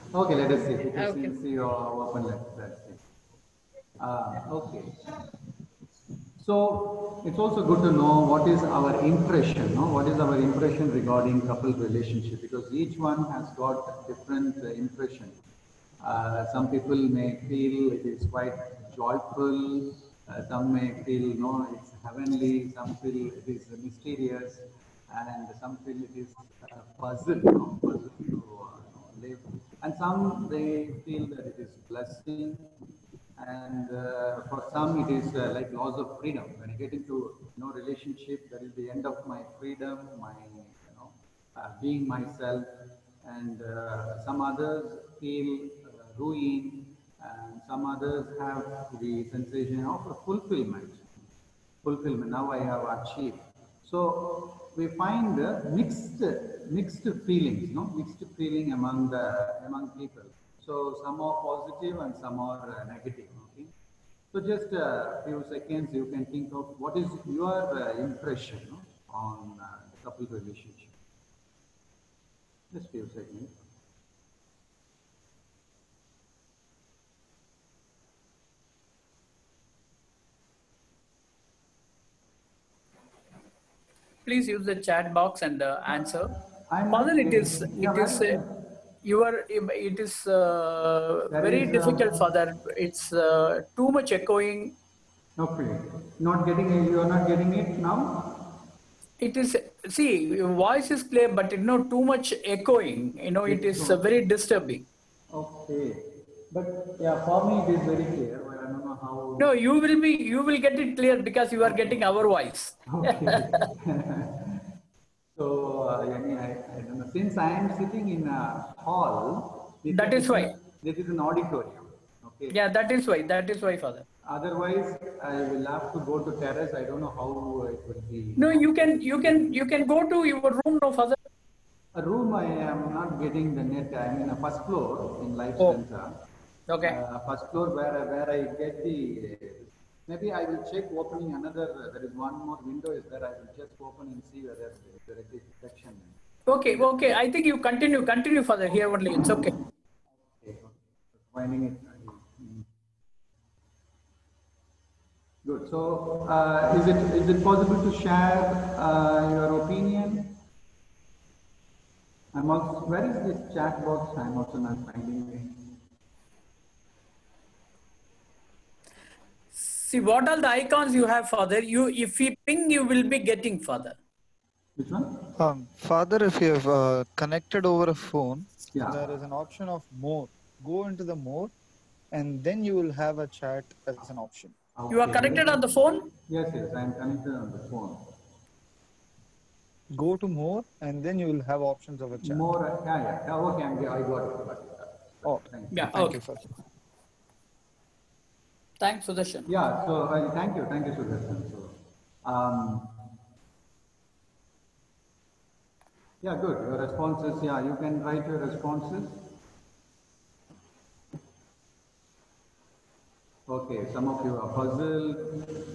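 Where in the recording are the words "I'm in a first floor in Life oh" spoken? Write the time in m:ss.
2:13.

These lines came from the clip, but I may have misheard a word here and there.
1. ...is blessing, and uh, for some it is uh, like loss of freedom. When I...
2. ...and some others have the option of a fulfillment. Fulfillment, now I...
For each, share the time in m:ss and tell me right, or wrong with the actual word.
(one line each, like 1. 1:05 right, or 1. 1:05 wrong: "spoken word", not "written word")
1. 0:31 right
2. 0:47 wrong: "sensation", not "option".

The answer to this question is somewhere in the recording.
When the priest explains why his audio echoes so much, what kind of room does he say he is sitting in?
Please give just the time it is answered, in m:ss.
2:01.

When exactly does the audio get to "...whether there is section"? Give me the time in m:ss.
2:24.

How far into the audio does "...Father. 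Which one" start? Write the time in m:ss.
2:53.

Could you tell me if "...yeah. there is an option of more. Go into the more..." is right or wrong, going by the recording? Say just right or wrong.
right.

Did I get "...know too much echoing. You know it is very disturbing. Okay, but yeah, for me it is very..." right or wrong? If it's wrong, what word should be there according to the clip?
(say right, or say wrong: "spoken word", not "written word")
right.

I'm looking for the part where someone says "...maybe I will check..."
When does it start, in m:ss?
2:20.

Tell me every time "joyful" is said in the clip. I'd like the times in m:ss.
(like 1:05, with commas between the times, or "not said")
0:18.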